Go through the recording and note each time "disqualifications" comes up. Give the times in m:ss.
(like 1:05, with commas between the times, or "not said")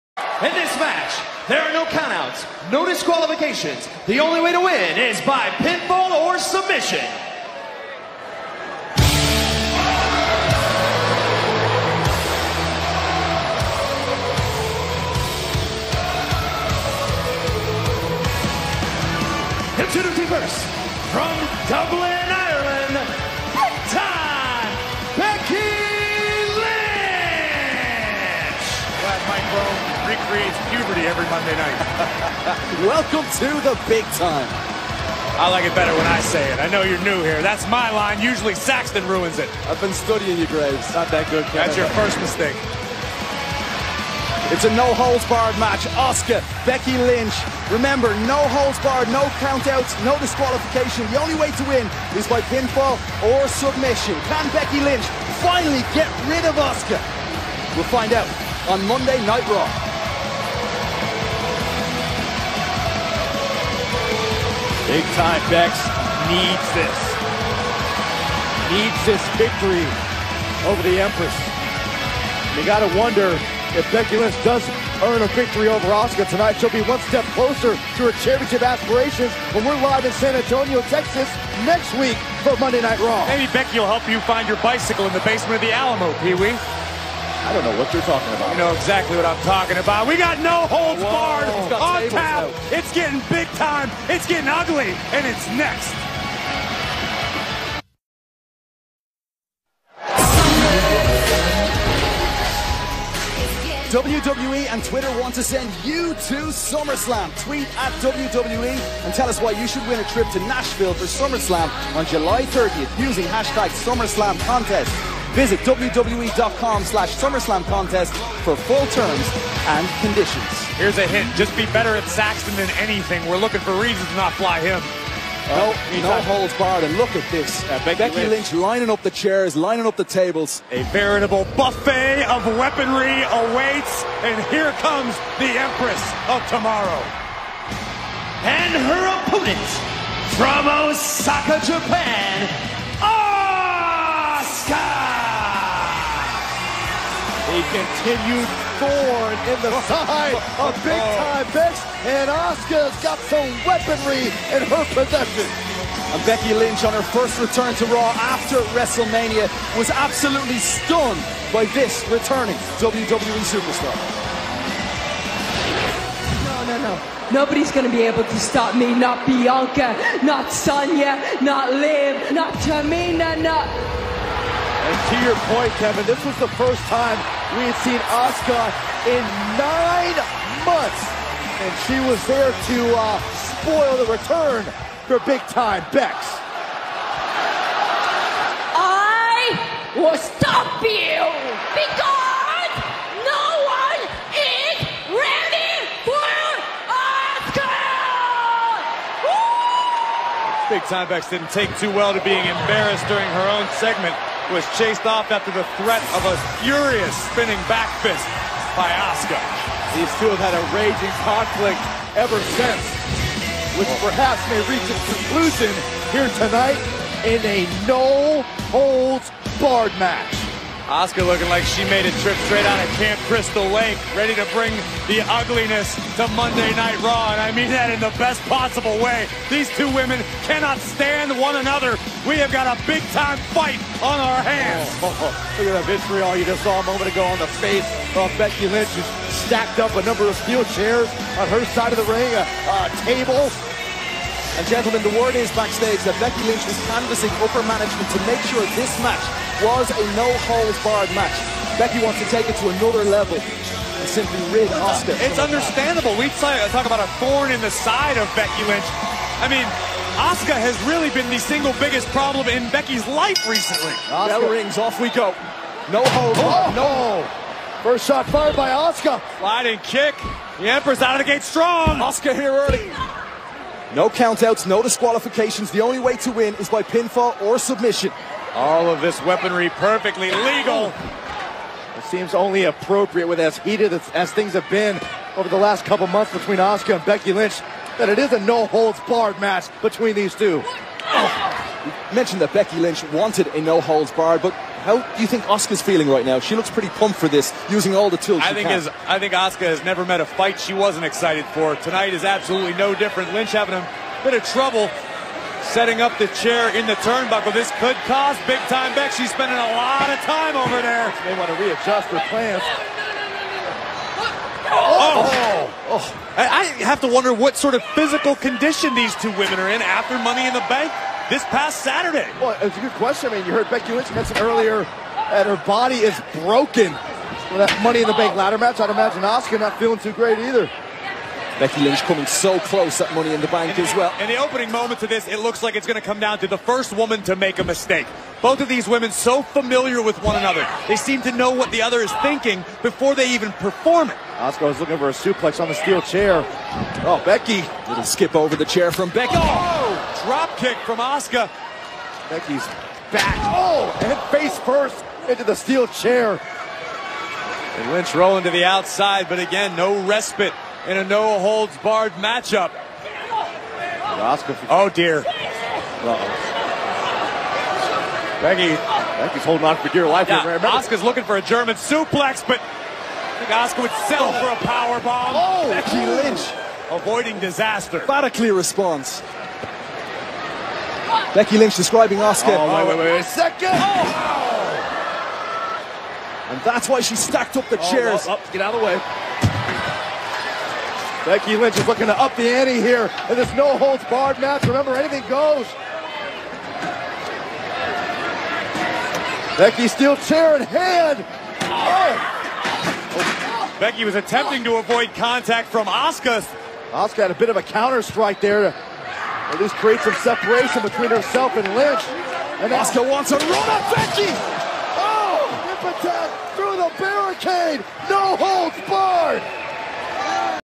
0:02, 0:50, 4:34.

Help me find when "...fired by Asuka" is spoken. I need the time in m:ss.
4:28.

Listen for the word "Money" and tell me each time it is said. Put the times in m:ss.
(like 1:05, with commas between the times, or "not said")
5:20, 5:27, 5:33.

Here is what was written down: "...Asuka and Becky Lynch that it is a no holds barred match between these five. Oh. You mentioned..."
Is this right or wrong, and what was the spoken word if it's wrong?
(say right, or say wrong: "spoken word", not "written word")
wrong: "two", not "five".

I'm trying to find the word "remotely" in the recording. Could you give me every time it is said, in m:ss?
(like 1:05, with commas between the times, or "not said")
not said.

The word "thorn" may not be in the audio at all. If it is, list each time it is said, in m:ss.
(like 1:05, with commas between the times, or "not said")
2:28, 4:17.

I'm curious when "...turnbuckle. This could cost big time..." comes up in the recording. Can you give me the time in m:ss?
5:07.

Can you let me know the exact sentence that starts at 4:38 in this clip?
All of this weaponry perfectly legal.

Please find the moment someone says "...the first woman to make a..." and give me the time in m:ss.
5:36.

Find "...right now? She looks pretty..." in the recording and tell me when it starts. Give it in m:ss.
4:56.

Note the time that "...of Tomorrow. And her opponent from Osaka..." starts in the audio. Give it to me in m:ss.
2:16.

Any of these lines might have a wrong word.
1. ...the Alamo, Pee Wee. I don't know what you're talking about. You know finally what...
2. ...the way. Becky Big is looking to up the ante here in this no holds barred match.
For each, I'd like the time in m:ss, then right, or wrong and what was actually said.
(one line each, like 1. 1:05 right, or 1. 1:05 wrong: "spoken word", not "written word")
1. 1:25 wrong: "exactly", not "finally"
2. 6:28 wrong: "Lynch", not "Big".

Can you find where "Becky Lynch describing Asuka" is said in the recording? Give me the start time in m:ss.
6:21.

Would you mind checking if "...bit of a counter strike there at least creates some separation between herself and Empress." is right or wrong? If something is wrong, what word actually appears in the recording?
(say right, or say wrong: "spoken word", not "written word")
wrong: "Lynch", not "Empress".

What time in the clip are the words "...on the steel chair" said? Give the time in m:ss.
5:45.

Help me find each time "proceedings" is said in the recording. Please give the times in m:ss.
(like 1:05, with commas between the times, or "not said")
not said.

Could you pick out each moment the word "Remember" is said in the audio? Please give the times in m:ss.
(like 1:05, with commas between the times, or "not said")
0:47, 6:34.